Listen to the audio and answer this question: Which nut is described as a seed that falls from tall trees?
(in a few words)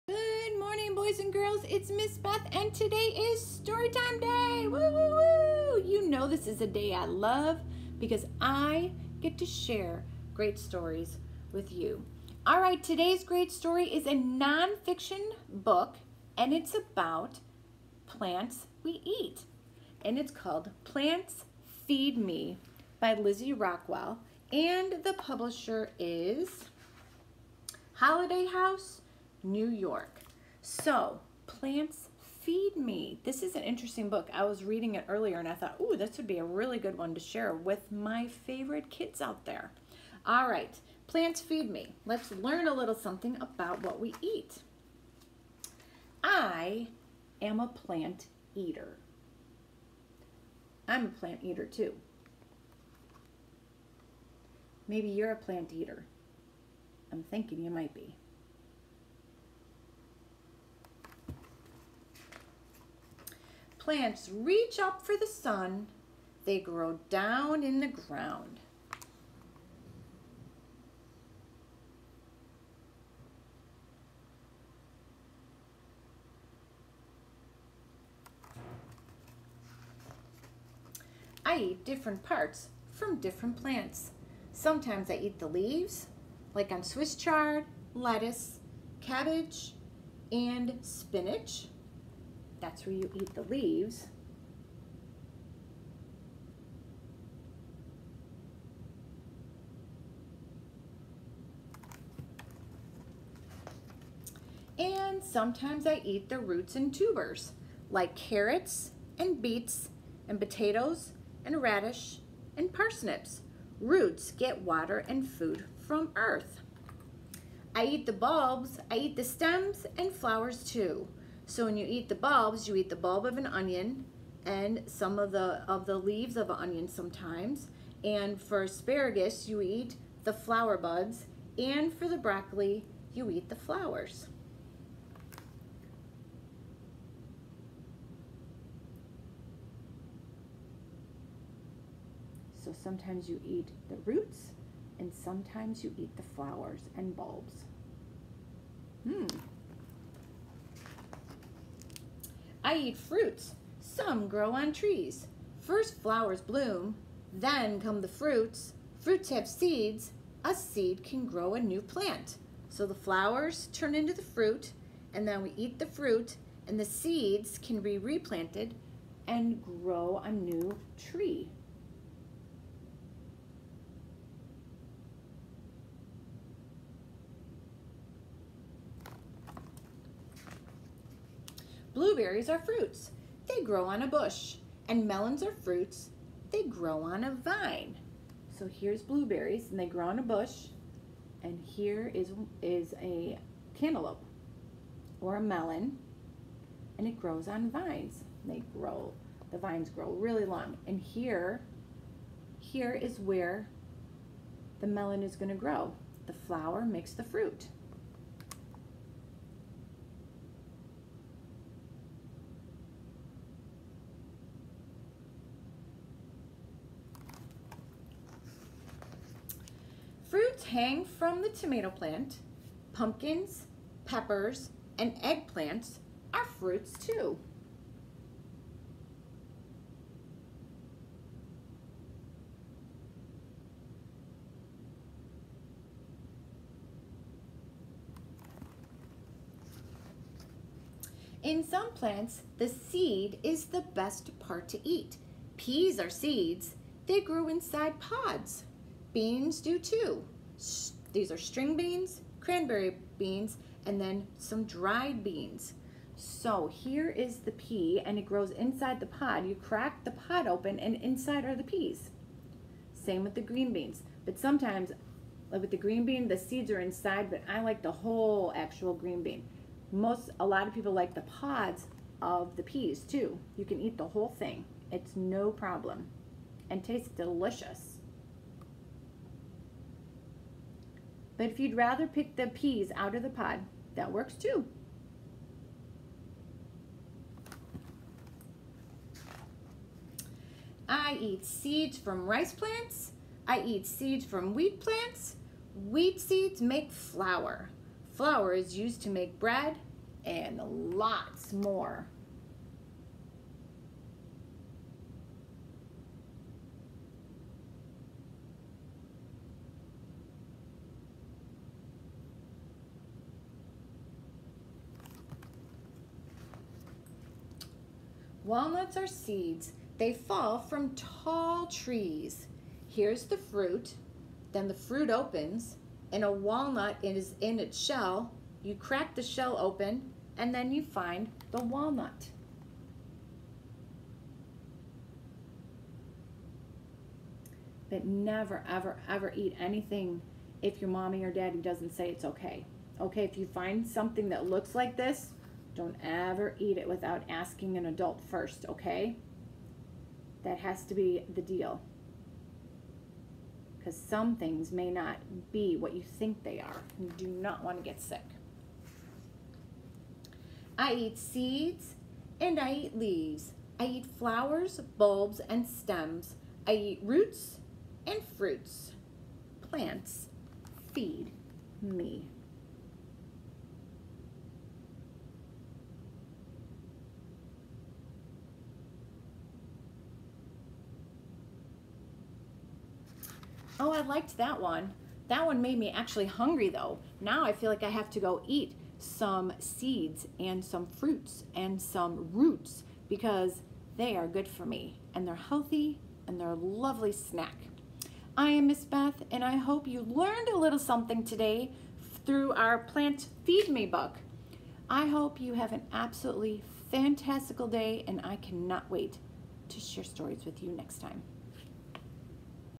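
Walnuts.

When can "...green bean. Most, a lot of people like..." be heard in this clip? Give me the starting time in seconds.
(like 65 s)
268 s.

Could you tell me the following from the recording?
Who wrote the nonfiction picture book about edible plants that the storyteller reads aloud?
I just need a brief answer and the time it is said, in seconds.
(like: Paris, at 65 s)
Lizzie Rockwell, at 23 s.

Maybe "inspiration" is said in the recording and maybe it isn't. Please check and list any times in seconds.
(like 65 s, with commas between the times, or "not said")
not said.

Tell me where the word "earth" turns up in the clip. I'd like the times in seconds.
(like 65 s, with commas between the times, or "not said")
116 s.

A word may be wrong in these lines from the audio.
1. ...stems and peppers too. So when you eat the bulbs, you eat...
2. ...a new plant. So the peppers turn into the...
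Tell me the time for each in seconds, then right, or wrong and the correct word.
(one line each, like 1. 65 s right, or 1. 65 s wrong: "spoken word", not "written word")
1. 119 s wrong: "flowers", not "peppers"
2. 161 s wrong: "flowers", not "peppers".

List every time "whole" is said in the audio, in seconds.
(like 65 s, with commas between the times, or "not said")
267 s, 274 s.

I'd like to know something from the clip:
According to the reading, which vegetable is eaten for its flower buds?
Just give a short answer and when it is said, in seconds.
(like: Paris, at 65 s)
Asparagus, at 128 s.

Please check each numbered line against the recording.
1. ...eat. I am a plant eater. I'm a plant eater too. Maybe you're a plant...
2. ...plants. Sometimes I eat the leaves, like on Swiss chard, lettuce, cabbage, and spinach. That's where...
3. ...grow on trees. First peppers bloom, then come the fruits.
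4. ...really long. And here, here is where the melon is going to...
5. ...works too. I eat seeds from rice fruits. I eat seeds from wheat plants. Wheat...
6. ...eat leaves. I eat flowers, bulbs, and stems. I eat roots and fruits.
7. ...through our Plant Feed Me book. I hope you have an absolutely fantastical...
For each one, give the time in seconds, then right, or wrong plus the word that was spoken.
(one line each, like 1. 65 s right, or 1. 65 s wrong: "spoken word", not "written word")
1. 44 s right
2. 83 s right
3. 154 s wrong: "flowers", not "peppers"
4. 200 s right
5. 284 s wrong: "plants", not "fruits"
6. 362 s right
7. 402 s right.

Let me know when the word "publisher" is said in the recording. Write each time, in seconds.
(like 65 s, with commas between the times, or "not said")
25 s.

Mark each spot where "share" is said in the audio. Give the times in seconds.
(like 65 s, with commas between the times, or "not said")
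9 s, 37 s, 409 s.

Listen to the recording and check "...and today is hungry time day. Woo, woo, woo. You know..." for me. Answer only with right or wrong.
wrong.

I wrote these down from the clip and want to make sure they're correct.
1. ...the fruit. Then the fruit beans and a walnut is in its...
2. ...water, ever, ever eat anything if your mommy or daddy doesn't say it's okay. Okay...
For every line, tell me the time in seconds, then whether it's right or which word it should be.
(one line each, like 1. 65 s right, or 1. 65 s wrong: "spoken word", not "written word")
1. 323 s wrong: "opens", not "beans"
2. 338 s wrong: "never", not "water".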